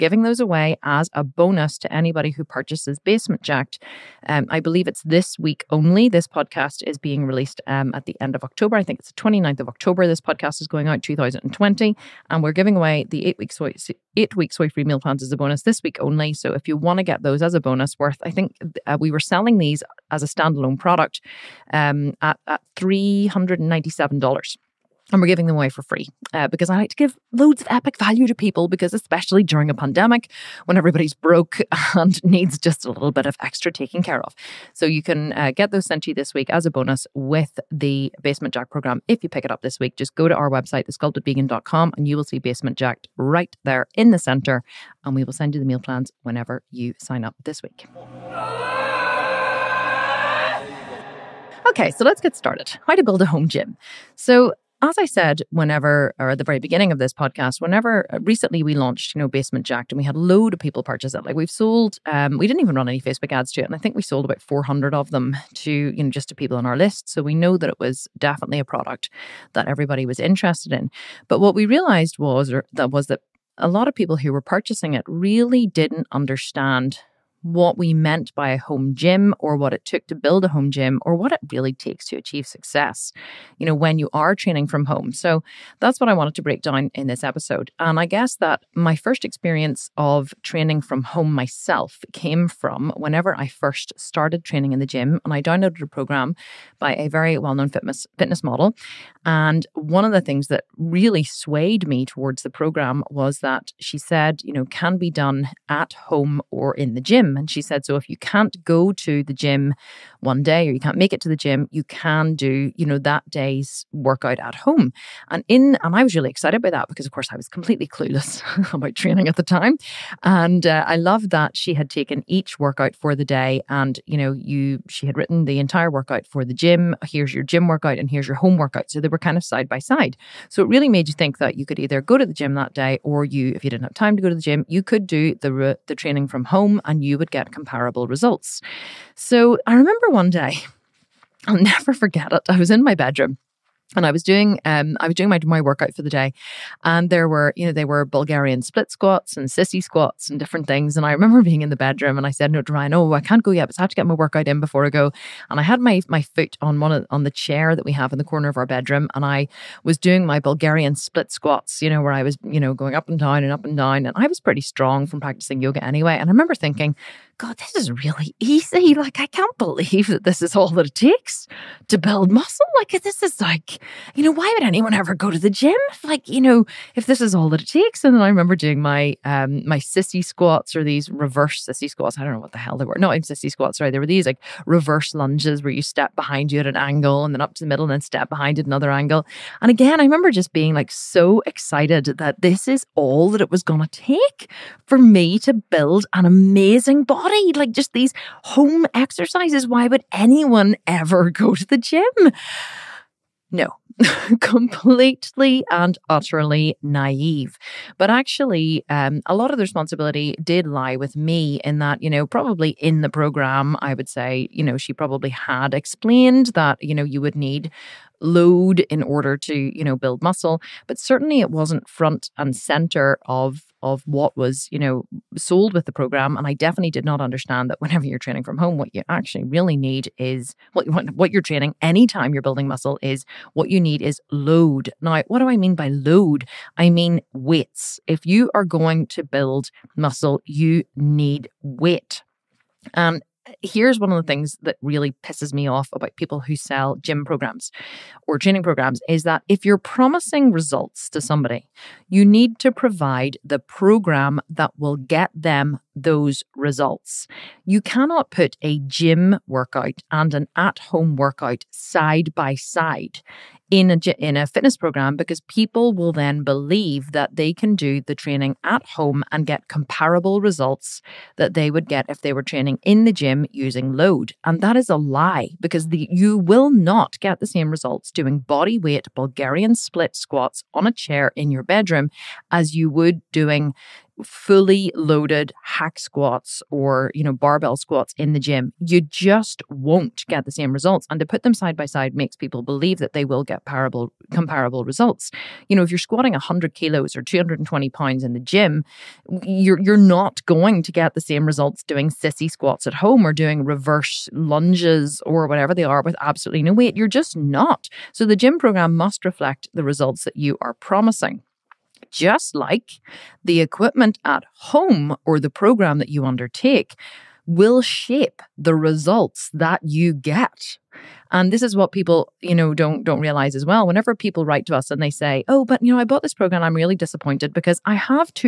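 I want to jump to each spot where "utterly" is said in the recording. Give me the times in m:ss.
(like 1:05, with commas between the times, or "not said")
3:26.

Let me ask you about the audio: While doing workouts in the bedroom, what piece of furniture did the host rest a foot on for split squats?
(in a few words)
A chair.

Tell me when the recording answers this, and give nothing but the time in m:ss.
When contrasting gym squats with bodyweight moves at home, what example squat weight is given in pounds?
4:57.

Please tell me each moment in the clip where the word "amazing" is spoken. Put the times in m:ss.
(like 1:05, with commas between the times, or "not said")
3:16.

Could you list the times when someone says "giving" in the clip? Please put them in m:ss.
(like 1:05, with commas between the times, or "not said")
0:12, 0:25.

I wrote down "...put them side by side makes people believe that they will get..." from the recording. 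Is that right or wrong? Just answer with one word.
right.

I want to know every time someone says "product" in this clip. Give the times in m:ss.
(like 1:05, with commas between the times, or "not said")
0:20, 1:08.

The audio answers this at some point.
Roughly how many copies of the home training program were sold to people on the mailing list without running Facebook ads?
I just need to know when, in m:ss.
1:04.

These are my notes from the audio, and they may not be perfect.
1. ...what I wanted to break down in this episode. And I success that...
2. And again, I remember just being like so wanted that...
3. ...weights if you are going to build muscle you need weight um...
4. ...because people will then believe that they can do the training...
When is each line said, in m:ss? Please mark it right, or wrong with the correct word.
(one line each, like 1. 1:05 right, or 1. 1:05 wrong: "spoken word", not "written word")
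1. 1:25 wrong: "guess", not "success"
2. 3:09 wrong: "excited", not "wanted"
3. 3:57 right
4. 4:25 right.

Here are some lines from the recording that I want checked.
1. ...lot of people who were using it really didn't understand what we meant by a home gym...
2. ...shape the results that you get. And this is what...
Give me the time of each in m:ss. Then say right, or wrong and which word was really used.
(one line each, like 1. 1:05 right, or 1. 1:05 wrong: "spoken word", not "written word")
1. 1:13 wrong: "purchasing", not "using"
2. 5:17 right.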